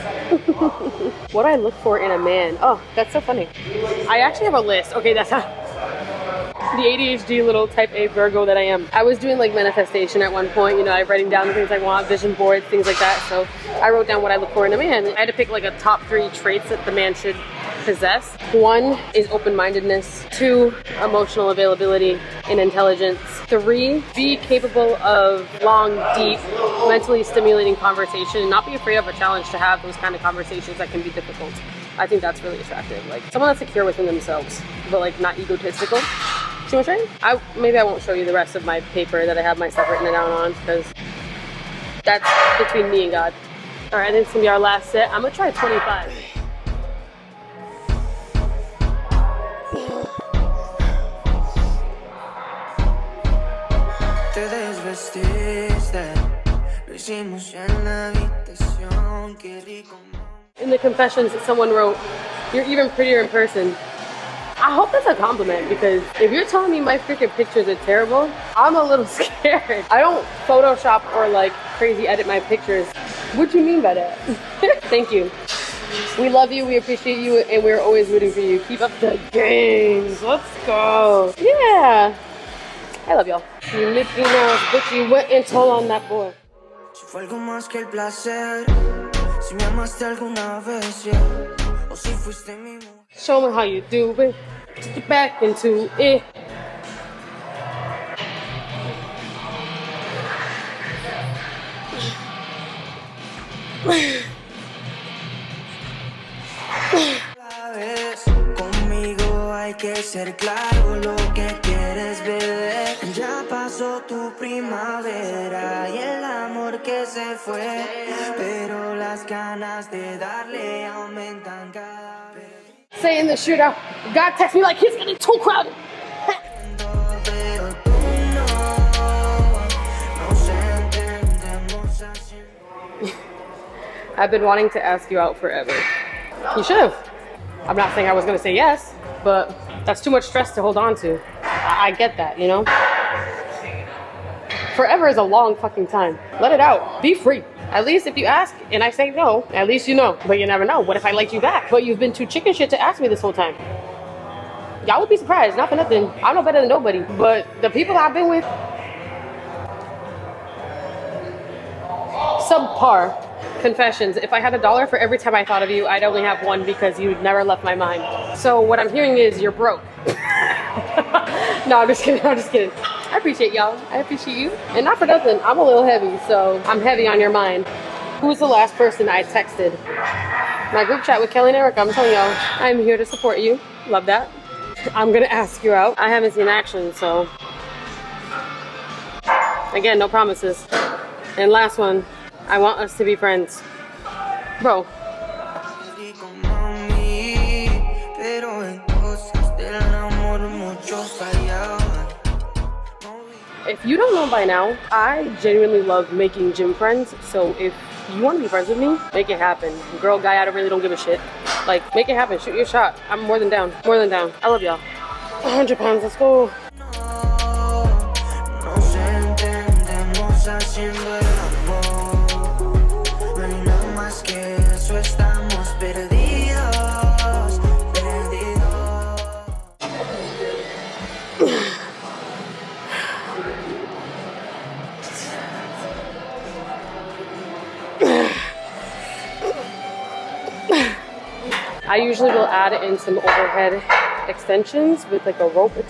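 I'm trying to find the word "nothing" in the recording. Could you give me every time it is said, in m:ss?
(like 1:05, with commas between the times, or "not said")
2:35, 2:55.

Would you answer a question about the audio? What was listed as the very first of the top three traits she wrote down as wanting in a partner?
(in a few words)
Open-mindedness.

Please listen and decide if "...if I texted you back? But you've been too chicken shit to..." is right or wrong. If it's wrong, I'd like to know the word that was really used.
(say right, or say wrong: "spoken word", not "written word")
wrong: "liked", not "texted".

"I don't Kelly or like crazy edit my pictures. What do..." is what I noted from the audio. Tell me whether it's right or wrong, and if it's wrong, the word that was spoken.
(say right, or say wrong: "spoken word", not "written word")
wrong: "Photoshop", not "Kelly".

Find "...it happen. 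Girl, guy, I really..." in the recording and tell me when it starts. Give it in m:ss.
3:29.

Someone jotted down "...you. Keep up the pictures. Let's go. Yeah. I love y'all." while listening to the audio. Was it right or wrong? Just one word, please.
wrong.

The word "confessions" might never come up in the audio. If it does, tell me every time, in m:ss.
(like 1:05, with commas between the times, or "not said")
1:00, 2:43.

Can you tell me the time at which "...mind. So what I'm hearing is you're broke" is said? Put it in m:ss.
2:47.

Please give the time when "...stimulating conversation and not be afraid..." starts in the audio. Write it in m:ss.
0:27.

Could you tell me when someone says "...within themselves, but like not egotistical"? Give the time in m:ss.
0:33.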